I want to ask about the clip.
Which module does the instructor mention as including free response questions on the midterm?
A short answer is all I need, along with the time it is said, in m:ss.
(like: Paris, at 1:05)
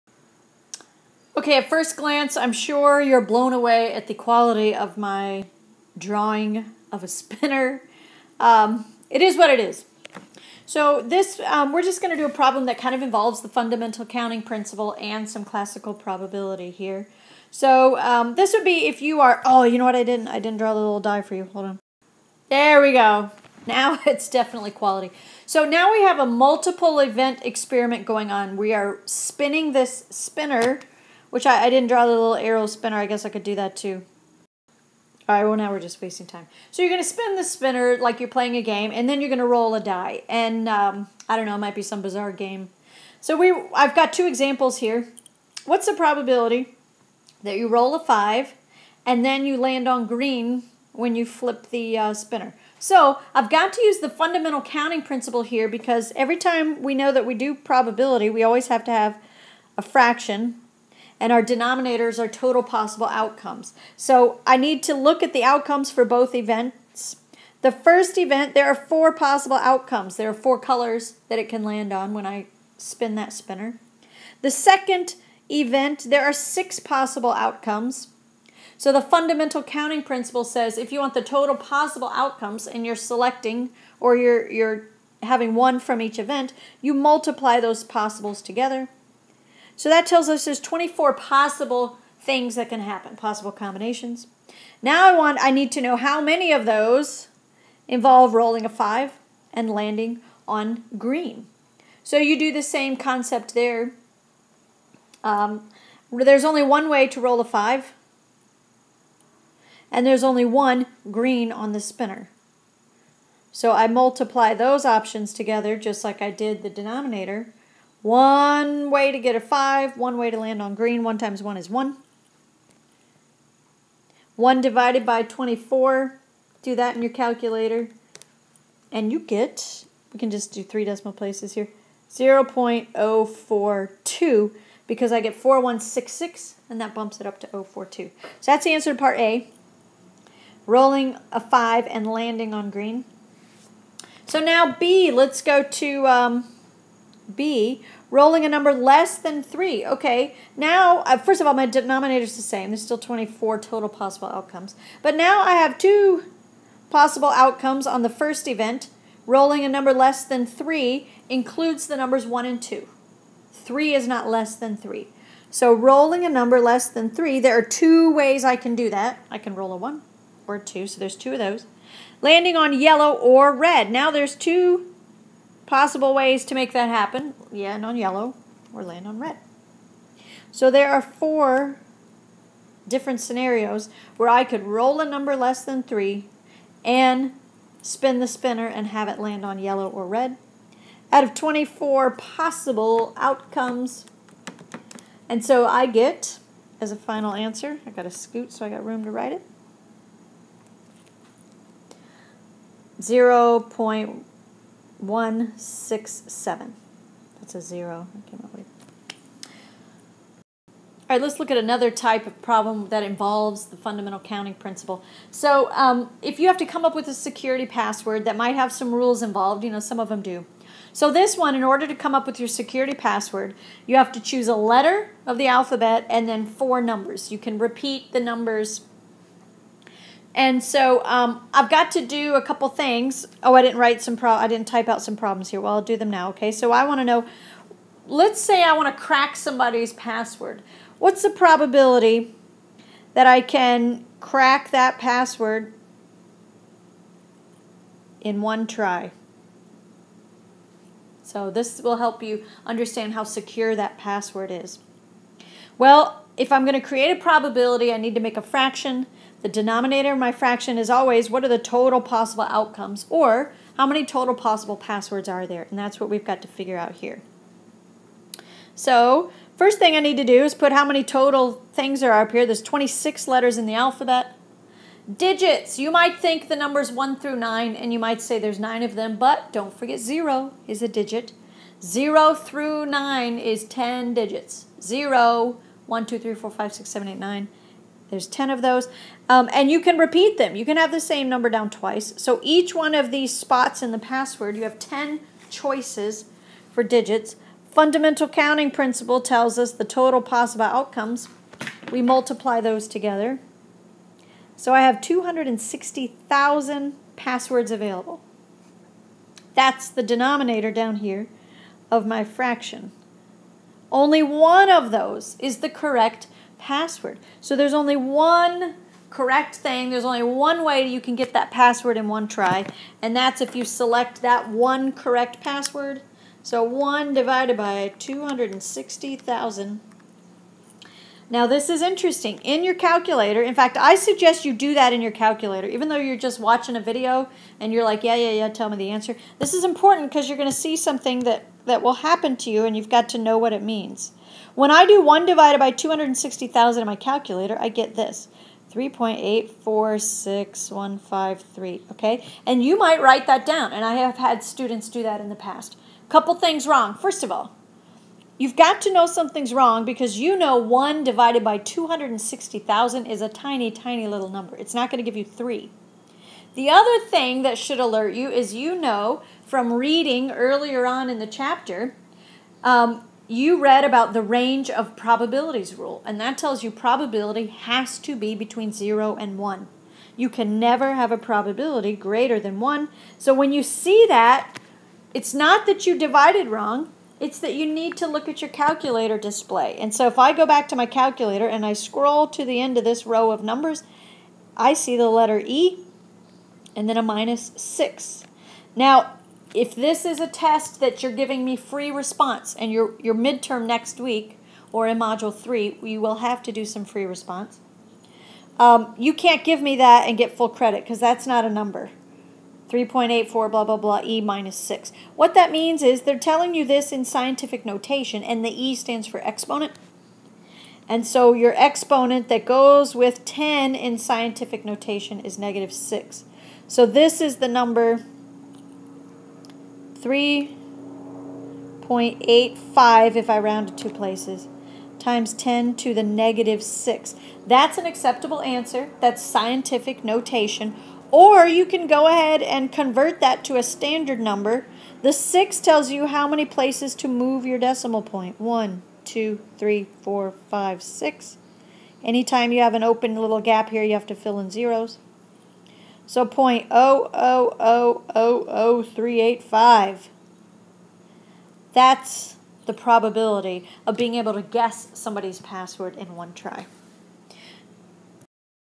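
module 3, at 6:44.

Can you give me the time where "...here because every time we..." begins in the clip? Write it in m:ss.
0:55.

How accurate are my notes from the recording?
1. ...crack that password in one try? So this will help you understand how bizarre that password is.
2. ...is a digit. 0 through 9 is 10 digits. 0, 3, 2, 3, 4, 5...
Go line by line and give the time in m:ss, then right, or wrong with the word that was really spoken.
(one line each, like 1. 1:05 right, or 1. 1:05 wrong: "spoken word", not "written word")
1. 4:04 wrong: "secure", not "bizarre"
2. 4:40 wrong: "1", not "3".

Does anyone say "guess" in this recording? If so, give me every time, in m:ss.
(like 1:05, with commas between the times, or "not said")
0:33, 7:44.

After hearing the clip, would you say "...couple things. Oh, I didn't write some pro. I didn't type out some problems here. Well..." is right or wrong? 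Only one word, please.
right.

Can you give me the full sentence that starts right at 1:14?
The second event, there are six possible outcomes.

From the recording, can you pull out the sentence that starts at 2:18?
So that's the answer to part A.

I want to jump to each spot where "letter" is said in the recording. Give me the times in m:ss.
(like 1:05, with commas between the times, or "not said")
3:44, 4:33, 6:35.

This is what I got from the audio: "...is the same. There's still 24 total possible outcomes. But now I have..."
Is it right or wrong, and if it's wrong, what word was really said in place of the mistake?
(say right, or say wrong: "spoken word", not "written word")
right.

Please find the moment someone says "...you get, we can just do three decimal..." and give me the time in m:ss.
2:09.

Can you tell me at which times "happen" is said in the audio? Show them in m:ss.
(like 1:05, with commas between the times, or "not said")
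1:32, 2:56, 5:41.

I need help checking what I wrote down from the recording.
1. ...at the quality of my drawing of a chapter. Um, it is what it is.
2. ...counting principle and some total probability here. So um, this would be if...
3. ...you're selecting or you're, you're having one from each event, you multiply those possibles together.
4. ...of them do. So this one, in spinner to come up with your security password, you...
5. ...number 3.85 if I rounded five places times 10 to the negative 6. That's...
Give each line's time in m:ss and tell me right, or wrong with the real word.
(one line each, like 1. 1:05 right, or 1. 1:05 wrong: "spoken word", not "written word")
1. 0:03 wrong: "spinner", not "chapter"
2. 0:14 wrong: "classical", not "total"
3. 1:22 right
4. 3:39 wrong: "order", not "spinner"
5. 7:07 wrong: "two", not "five".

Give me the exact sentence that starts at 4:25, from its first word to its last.
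And that's what we've got to figure out here.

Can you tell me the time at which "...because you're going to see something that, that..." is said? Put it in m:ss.
5:40.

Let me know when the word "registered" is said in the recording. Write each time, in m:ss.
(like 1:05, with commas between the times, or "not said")
not said.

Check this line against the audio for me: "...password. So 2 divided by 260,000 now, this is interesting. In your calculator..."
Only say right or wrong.
wrong.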